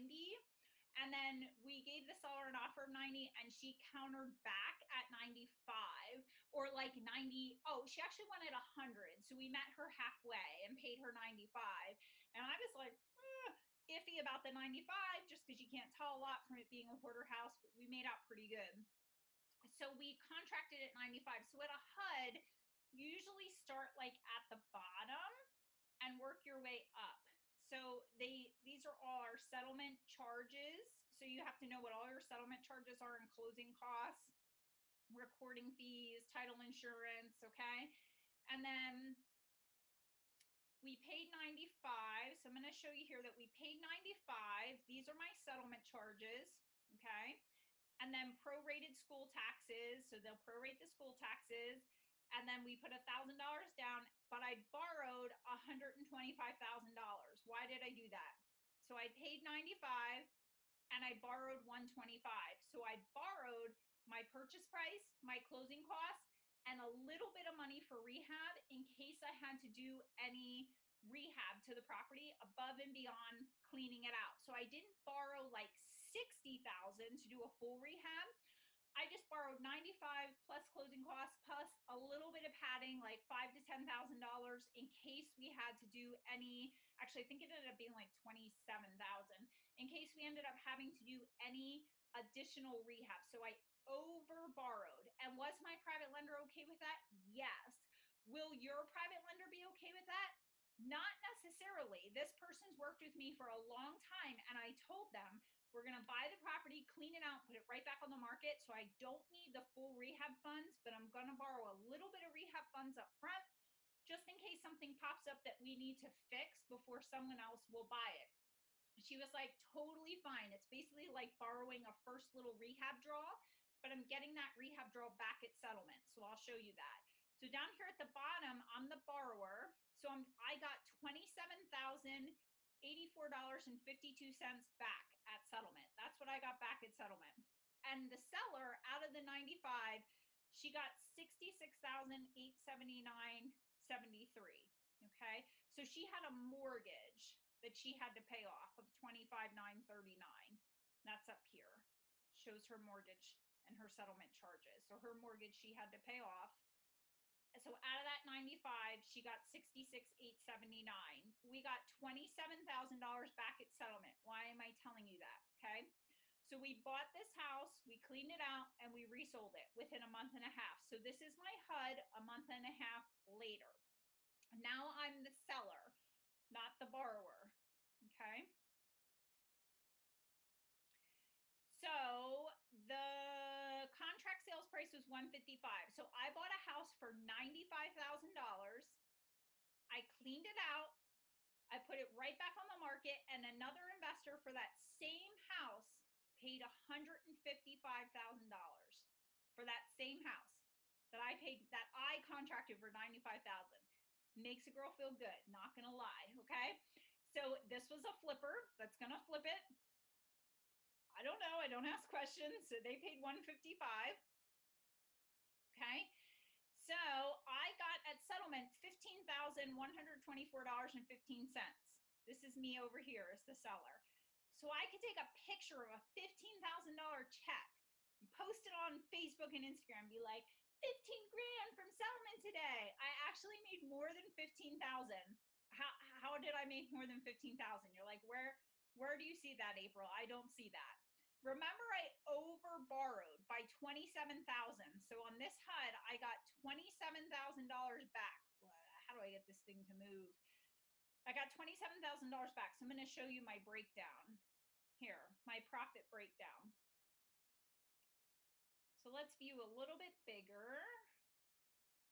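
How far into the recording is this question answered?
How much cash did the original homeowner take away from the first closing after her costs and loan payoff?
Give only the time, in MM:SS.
02:21.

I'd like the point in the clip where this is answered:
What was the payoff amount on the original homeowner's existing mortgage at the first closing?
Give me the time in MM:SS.
02:28.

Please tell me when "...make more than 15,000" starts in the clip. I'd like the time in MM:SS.
03:56.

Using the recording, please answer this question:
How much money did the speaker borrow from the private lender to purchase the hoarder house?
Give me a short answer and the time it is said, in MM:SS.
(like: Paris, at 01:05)
$125,000, at 00:55.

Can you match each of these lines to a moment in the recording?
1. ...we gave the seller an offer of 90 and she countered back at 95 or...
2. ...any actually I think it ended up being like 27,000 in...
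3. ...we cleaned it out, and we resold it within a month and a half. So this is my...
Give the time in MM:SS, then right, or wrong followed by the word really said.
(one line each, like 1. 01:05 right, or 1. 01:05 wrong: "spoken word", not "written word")
1. 00:01 right
2. 01:26 right
3. 02:47 right.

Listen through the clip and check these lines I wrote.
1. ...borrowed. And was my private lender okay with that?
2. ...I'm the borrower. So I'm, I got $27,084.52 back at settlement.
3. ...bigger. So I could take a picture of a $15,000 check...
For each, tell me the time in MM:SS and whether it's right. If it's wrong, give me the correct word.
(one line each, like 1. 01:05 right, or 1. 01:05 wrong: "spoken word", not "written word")
1. 01:34 right
2. 02:08 right
3. 03:43 wrong: "seller", not "bigger".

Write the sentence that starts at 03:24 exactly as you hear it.
Makes a girl feel good, not going to lie, okay?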